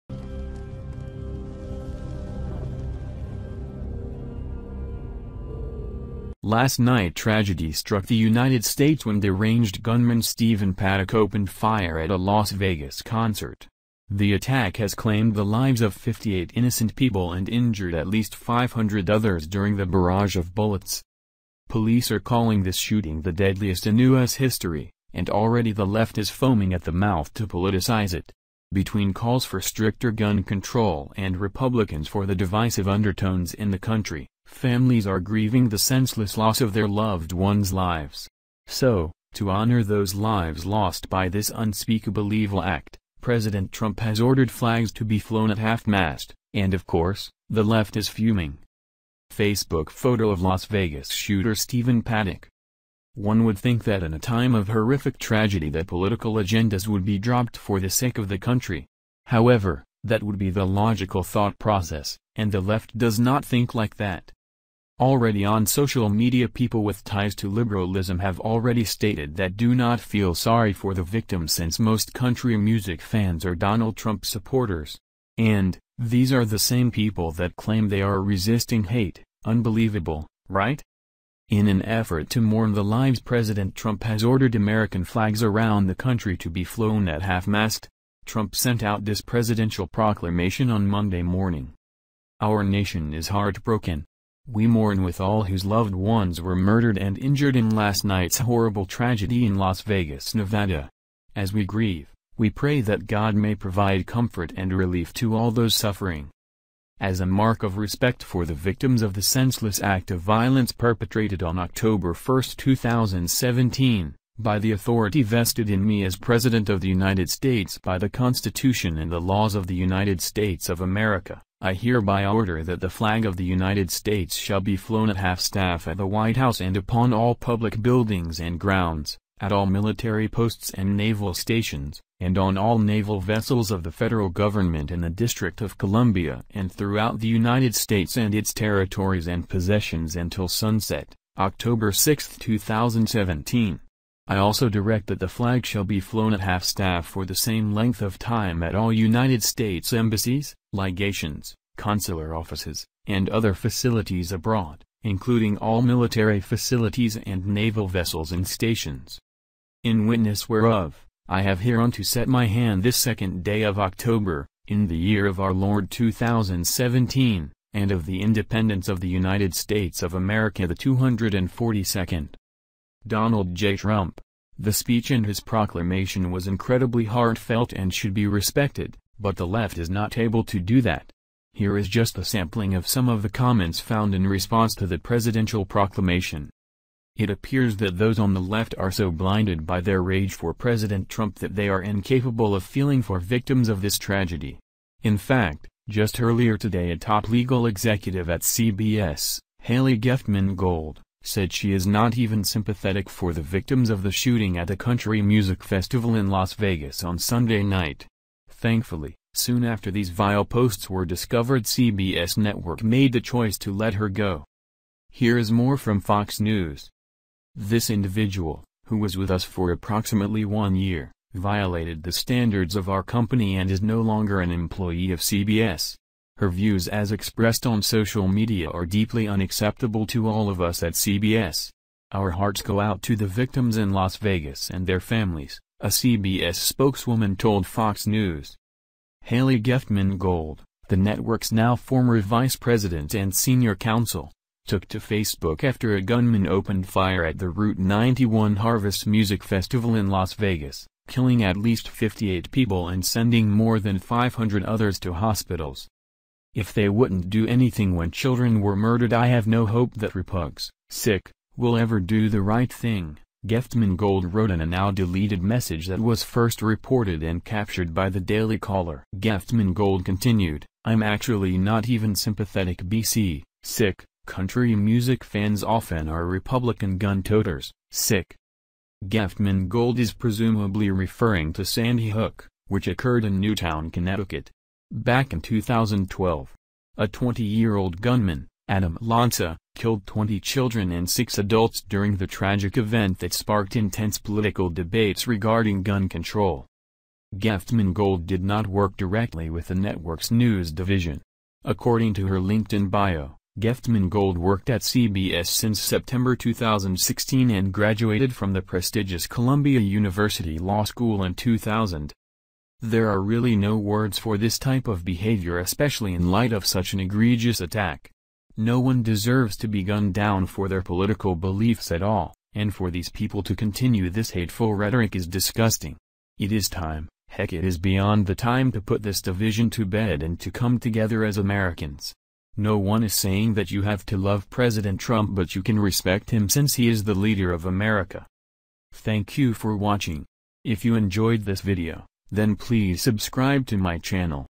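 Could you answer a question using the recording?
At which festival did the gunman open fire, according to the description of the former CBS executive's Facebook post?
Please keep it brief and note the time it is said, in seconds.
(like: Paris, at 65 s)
Route 91 Harvest Music Festival, at 247 s.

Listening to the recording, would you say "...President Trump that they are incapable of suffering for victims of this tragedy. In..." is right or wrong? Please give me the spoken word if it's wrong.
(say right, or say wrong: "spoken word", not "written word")
wrong: "feeling", not "suffering".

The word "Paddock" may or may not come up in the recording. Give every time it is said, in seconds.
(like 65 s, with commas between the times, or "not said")
10 s, 52 s.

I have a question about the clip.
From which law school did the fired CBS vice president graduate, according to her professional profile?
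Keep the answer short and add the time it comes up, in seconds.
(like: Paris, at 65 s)
Columbia University Law School, at 309 s.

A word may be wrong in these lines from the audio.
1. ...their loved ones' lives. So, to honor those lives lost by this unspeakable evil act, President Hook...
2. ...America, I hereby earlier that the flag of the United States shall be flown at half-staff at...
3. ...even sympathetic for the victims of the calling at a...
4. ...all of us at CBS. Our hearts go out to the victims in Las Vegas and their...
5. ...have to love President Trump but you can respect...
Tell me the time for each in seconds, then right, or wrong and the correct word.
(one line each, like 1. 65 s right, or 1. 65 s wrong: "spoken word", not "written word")
1. 36 s wrong: "Trump", not "Hook"
2. 120 s wrong: "order", not "earlier"
3. 202 s wrong: "shooting", not "calling"
4. 230 s right
5. 333 s right.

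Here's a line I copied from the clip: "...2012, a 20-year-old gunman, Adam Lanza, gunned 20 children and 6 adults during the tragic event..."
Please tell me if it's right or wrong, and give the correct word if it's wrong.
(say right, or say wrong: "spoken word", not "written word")
wrong: "killed", not "gunned".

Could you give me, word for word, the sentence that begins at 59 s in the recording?
However, that would be the logical thought process, and the left does not think like that.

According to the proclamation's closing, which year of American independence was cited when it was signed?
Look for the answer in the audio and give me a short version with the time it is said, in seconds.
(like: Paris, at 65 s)
242nd, at 170 s.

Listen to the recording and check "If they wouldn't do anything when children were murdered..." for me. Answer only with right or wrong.
right.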